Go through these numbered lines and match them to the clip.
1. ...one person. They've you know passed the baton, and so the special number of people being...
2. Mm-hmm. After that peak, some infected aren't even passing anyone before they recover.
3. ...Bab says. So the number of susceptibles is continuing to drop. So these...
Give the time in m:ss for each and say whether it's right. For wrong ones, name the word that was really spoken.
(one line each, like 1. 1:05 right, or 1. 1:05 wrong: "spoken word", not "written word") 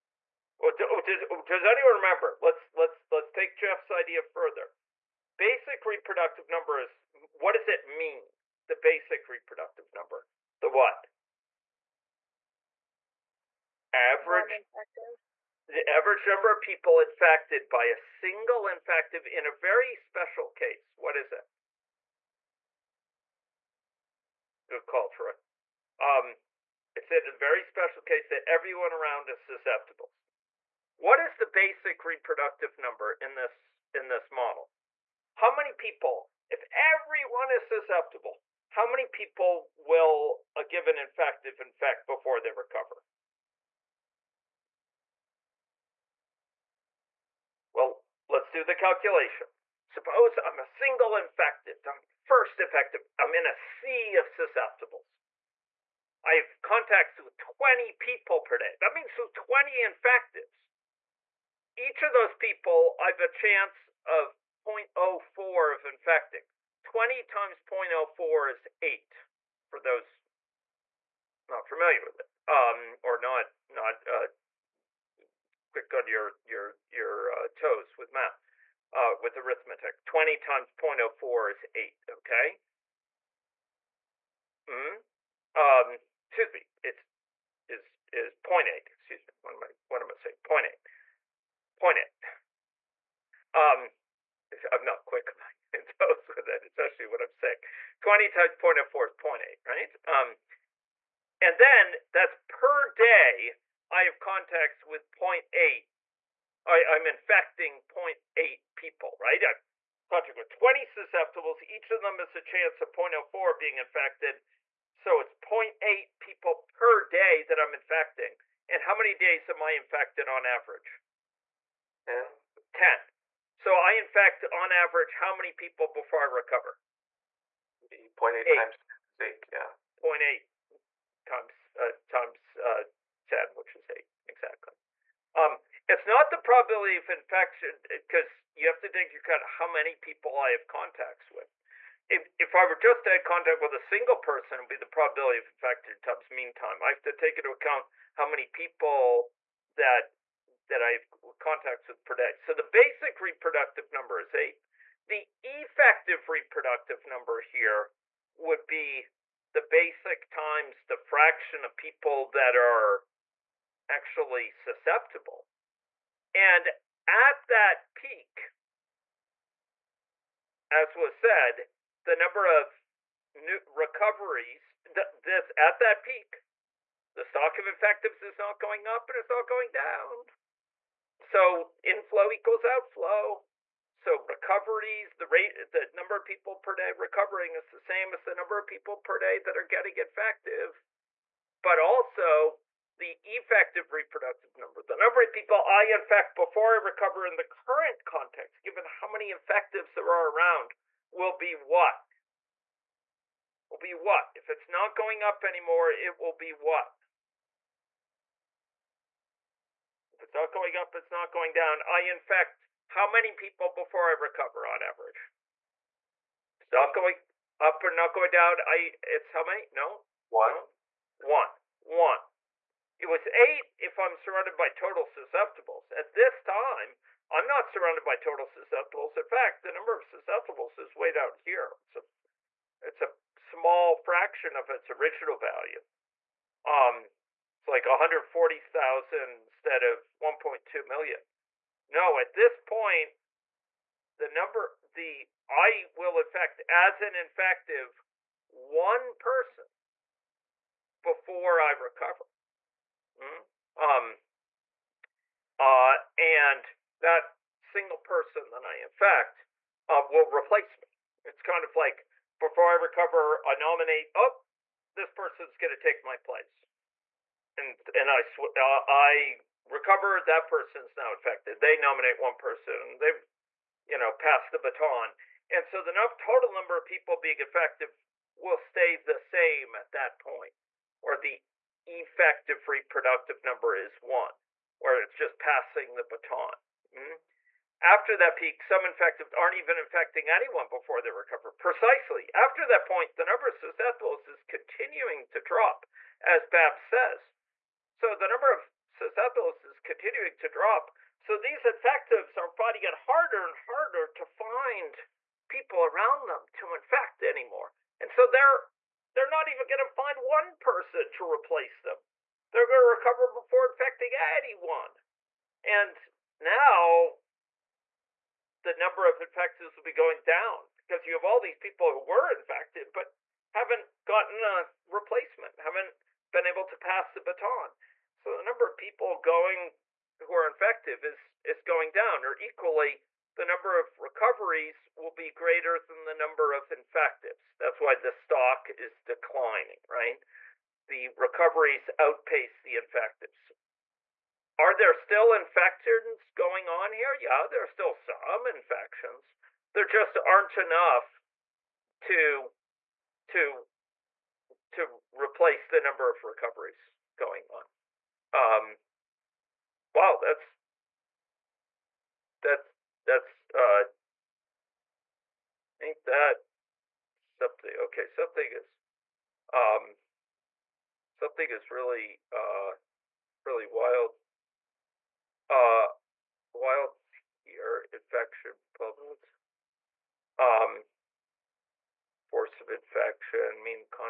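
1. 4:32 wrong: "total", not "special"
2. 4:46 wrong: "infecting", not "passing"
3. 4:56 right.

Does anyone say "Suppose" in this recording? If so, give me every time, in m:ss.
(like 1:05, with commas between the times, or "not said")
0:49.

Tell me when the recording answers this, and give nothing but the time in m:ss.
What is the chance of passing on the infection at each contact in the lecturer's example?
1:02.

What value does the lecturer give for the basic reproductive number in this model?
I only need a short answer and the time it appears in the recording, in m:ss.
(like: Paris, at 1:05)
8, at 2:32.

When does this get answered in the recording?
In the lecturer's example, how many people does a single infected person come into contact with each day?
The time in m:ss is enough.
0:56.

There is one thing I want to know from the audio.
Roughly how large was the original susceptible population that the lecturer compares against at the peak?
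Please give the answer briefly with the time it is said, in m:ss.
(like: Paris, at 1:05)
1.2 million, at 4:00.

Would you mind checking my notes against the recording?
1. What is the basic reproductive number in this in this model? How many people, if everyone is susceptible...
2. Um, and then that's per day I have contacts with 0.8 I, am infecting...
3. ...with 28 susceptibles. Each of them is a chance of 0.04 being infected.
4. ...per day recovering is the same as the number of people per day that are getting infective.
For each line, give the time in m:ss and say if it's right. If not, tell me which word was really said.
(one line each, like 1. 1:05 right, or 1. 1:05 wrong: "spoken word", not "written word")
1. 0:30 right
2. 1:40 right
3. 1:50 wrong: "20", not "28"
4. 3:06 right.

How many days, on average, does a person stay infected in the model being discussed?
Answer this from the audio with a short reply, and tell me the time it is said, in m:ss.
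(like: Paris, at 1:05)
10, at 2:02.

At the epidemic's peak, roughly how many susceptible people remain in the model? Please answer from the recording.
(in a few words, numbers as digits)
140,000.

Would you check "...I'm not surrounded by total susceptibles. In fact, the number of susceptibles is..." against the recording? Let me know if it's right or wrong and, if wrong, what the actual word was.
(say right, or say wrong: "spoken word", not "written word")
right.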